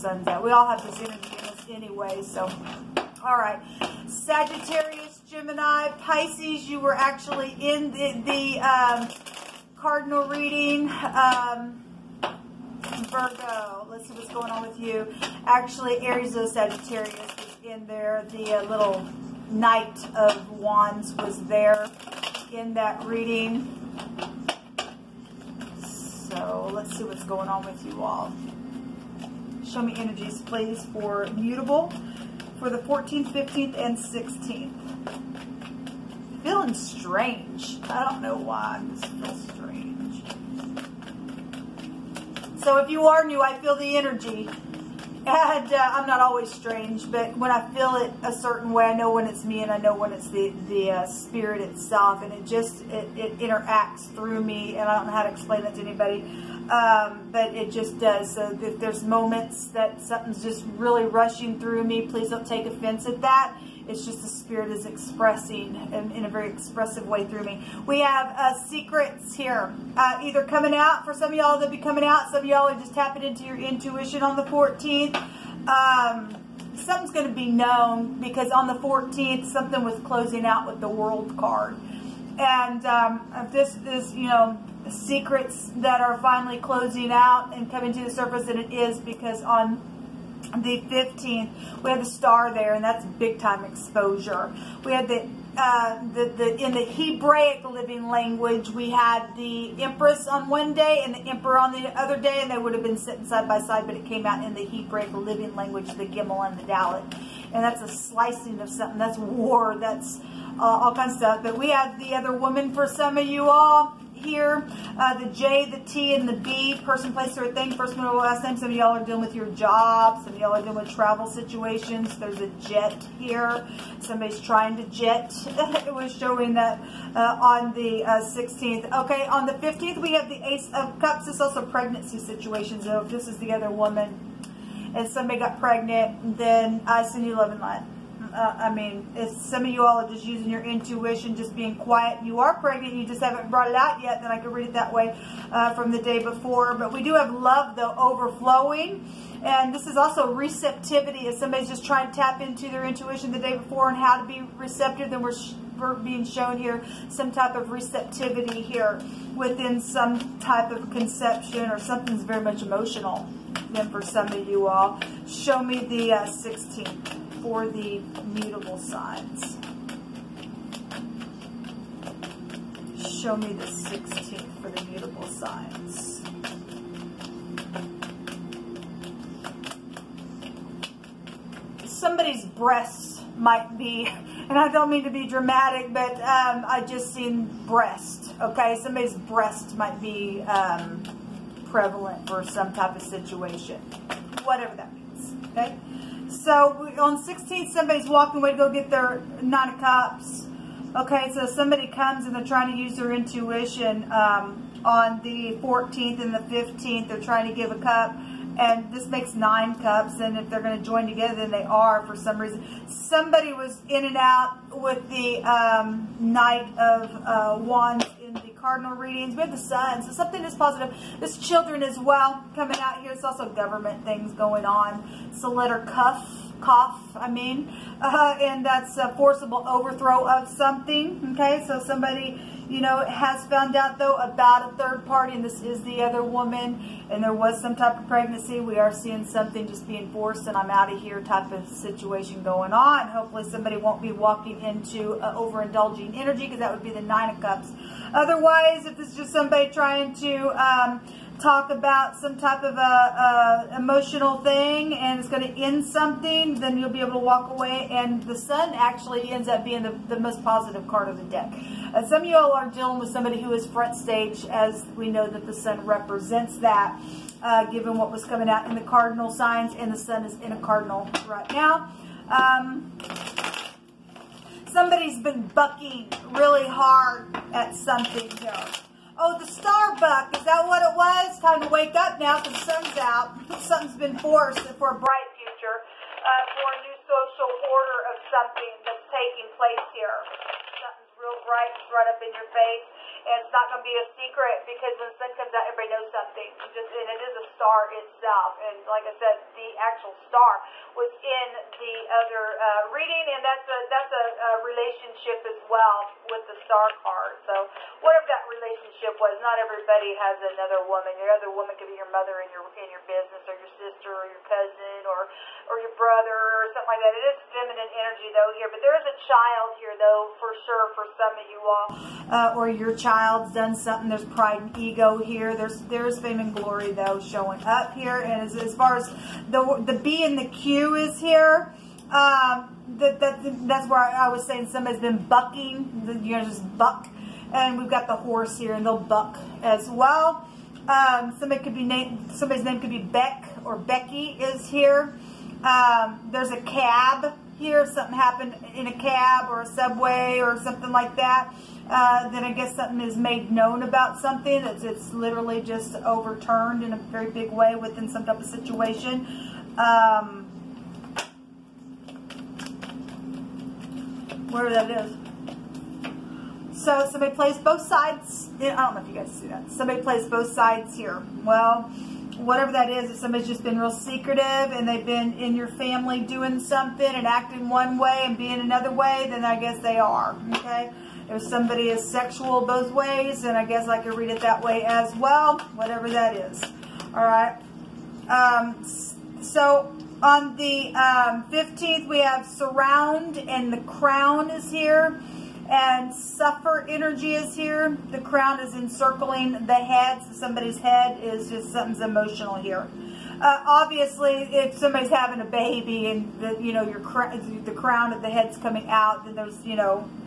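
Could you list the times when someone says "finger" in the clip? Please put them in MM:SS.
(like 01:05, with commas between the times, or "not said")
not said.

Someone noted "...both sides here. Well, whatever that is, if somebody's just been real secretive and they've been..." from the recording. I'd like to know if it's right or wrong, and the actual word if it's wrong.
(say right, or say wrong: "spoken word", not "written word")
right.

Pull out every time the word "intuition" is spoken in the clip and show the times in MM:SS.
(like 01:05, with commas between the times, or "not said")
01:13, 02:20, 02:32, 03:23.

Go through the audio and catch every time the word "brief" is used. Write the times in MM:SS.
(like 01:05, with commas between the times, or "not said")
not said.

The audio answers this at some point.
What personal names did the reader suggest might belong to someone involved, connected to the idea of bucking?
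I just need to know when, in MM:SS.
05:42.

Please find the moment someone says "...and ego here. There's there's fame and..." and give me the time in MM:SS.
05:24.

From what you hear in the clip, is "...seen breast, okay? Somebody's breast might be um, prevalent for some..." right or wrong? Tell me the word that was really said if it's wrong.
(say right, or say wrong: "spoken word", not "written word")
right.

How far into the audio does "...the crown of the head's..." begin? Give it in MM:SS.
06:47.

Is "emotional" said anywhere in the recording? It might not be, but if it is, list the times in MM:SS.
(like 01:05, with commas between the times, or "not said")
02:42, 04:13, 06:41.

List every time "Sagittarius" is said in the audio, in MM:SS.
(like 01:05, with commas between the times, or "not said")
00:04, 00:16.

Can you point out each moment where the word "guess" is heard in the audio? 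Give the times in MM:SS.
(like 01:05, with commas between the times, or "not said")
05:52, 06:19, 06:23.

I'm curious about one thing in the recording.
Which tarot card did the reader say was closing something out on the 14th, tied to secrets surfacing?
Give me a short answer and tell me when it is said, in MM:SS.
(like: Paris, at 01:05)
The World, at 01:20.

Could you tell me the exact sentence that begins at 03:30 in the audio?
And if they're going to join together, then they are for some reason.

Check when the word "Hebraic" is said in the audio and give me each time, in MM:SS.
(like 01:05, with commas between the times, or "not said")
01:36, 01:44.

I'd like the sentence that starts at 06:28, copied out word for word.
Um, so on the um, 15th, we have surround and the crown is here and suffer energy is here.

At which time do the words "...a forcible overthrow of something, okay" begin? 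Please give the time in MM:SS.
03:48.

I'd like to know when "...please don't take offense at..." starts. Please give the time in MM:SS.
01:02.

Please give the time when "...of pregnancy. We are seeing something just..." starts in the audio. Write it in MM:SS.
03:57.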